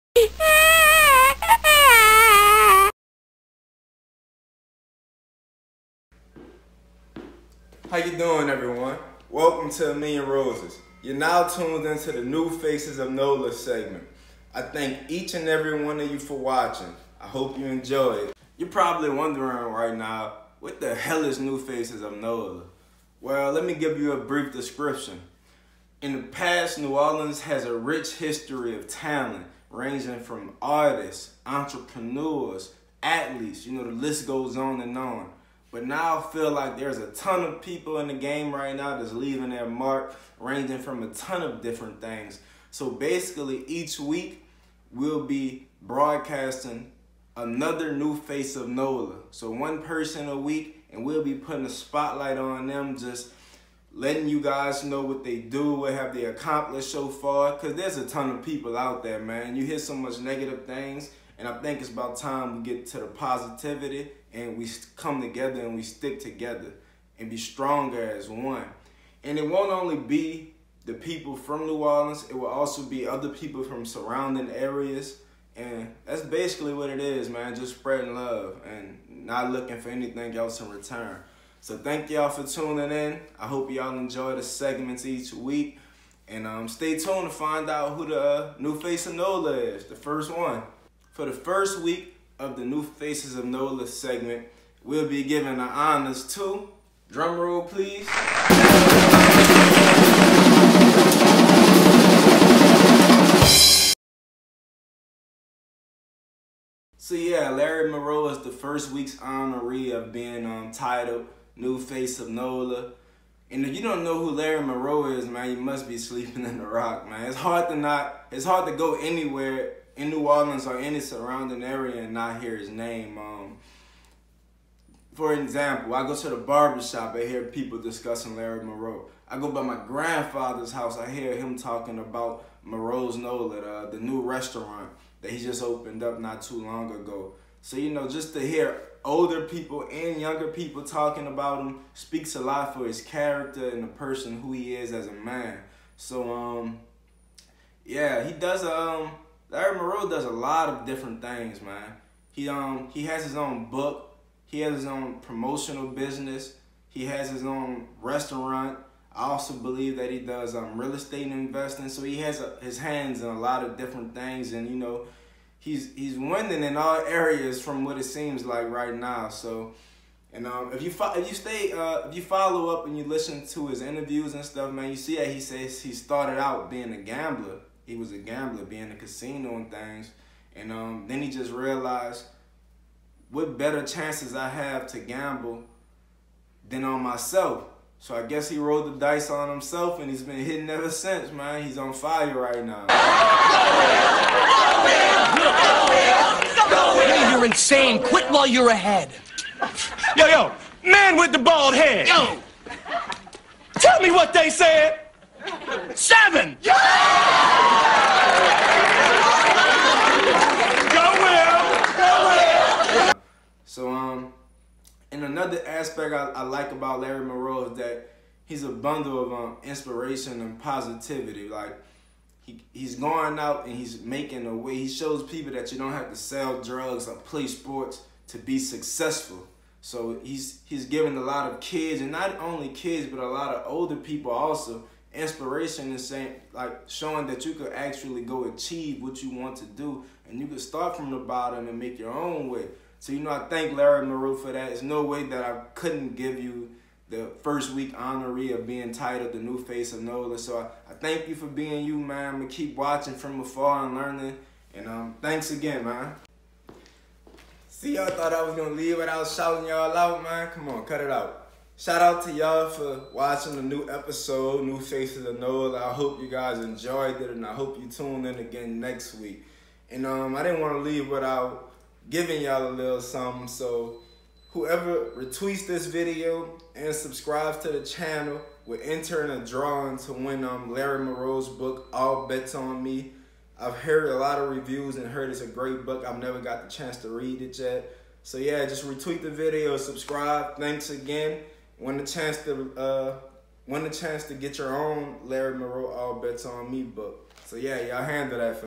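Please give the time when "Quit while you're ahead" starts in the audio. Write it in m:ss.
3:18.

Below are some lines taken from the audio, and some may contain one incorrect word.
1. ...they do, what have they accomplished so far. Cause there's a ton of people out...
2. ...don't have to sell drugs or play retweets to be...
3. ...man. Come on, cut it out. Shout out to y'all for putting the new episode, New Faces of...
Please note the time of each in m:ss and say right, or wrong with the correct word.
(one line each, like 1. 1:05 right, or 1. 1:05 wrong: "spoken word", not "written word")
1. 0:55 right
2. 3:45 wrong: "sports", not "retweets"
3. 4:20 wrong: "watching", not "putting".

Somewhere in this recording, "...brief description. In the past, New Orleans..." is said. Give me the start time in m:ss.
0:24.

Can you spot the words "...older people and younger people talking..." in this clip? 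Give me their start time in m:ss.
2:19.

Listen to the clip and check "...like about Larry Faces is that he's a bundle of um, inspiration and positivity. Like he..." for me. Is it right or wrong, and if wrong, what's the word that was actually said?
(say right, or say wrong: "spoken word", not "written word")
wrong: "Morrow", not "Faces".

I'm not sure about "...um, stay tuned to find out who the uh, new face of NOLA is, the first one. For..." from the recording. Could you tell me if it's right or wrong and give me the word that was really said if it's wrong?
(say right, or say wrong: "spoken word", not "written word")
right.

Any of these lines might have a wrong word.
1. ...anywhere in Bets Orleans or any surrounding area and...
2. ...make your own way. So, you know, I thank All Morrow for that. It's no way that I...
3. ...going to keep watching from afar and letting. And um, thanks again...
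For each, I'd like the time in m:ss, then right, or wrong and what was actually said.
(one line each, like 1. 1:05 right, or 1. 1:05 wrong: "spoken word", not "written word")
1. 1:58 wrong: "New", not "Bets"
2. 4:01 wrong: "Larry", not "All"
3. 4:12 wrong: "learning", not "letting".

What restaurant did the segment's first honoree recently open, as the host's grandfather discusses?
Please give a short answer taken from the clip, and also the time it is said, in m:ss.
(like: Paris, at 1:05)
Morrow's Nola, at 2:12.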